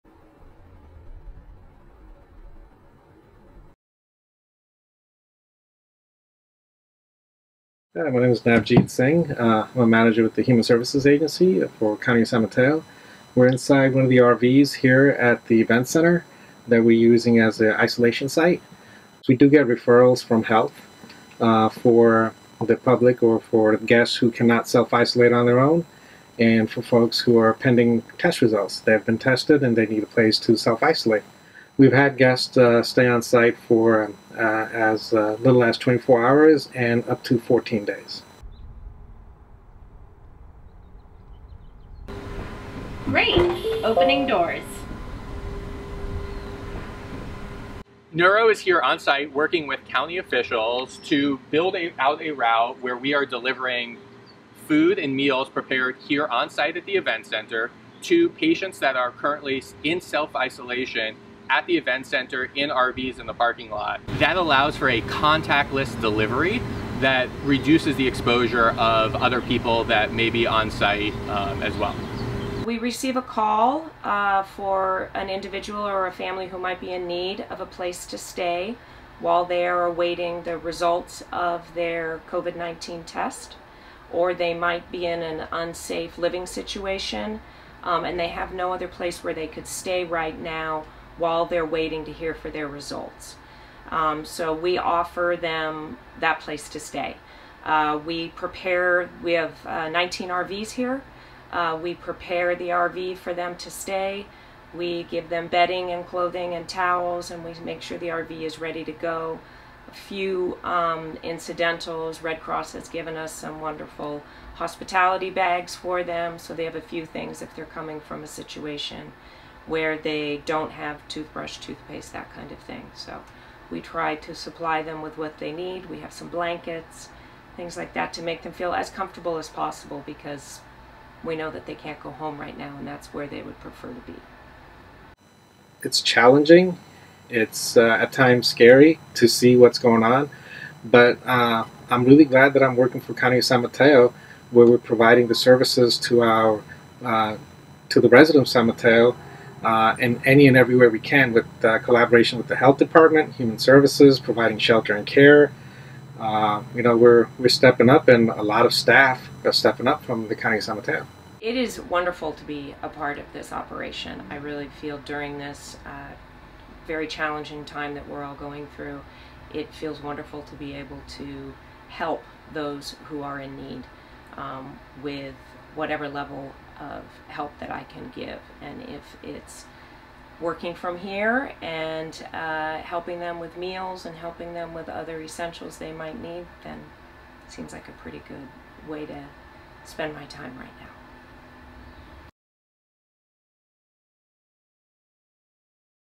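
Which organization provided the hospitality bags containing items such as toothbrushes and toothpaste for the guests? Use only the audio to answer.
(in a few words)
Red Cross.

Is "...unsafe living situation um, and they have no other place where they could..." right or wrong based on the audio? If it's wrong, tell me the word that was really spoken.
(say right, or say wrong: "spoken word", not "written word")
right.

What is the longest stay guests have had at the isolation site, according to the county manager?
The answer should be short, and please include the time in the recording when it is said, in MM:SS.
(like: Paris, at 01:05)
14 days, at 00:37.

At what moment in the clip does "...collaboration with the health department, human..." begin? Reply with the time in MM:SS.
02:31.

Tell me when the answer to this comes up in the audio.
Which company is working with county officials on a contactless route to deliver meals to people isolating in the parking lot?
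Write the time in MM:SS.
00:48.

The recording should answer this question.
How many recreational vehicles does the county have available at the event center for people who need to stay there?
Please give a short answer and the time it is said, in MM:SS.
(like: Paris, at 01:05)
19, at 01:39.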